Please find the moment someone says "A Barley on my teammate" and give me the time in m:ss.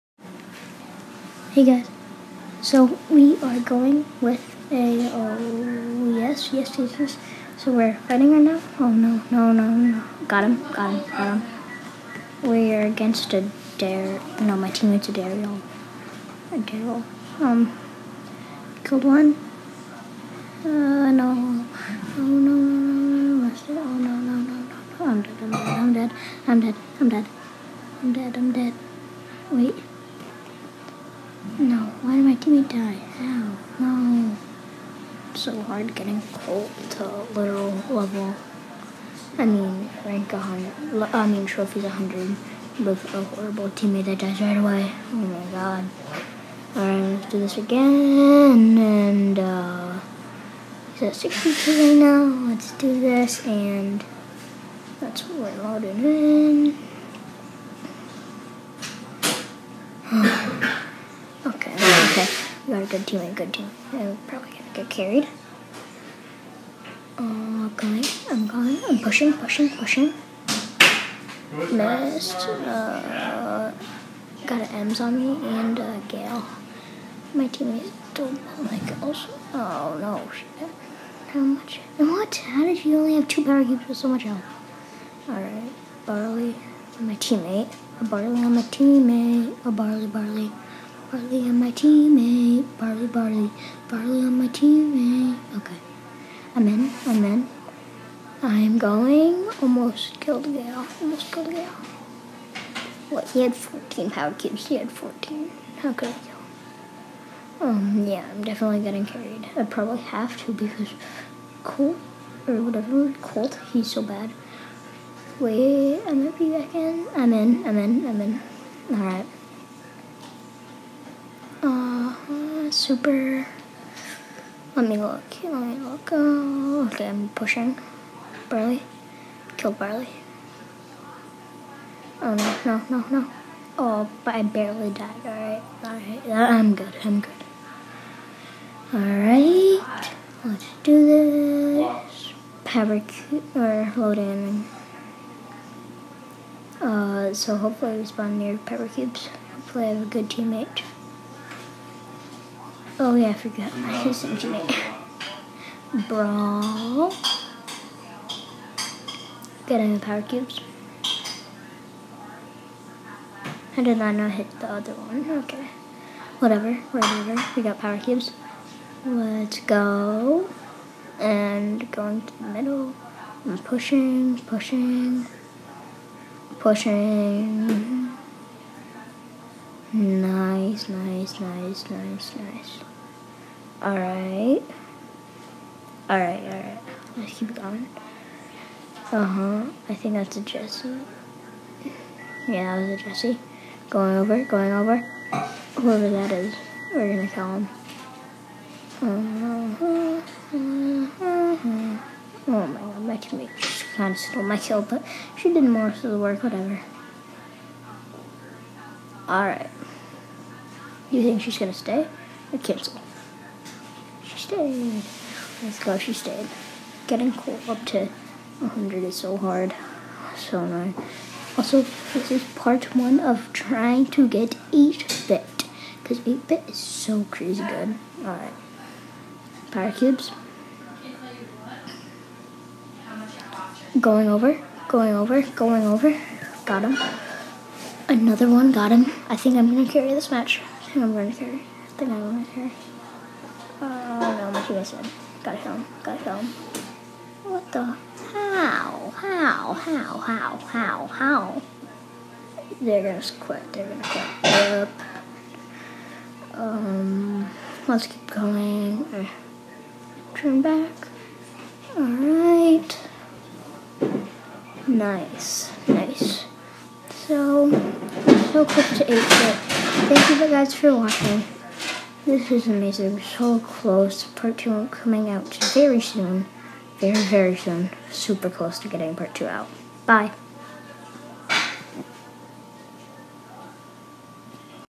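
1:27.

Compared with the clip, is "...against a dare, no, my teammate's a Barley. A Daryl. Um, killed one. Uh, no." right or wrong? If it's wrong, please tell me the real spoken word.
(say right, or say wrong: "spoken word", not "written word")
wrong: "Daryl", not "Barley".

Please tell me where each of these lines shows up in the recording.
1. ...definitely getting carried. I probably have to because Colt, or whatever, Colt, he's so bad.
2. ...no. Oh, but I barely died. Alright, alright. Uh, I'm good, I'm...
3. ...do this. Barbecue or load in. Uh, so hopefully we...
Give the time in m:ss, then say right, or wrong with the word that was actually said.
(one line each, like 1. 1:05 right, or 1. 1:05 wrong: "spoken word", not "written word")
1. 1:48 right
2. 2:13 right
3. 2:20 right.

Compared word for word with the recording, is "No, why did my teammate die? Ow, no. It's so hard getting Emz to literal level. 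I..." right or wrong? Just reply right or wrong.
wrong.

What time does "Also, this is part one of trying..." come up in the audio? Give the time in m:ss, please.
3:41.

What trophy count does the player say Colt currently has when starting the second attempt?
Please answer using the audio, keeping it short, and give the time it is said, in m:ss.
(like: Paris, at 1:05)
62, at 0:51.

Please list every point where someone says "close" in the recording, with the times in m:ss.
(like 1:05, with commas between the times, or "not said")
4:33, 4:38.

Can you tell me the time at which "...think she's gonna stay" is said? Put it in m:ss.
3:31.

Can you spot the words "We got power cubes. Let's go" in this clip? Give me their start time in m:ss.
2:47.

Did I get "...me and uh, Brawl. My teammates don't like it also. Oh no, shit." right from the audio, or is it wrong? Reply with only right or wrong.
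wrong.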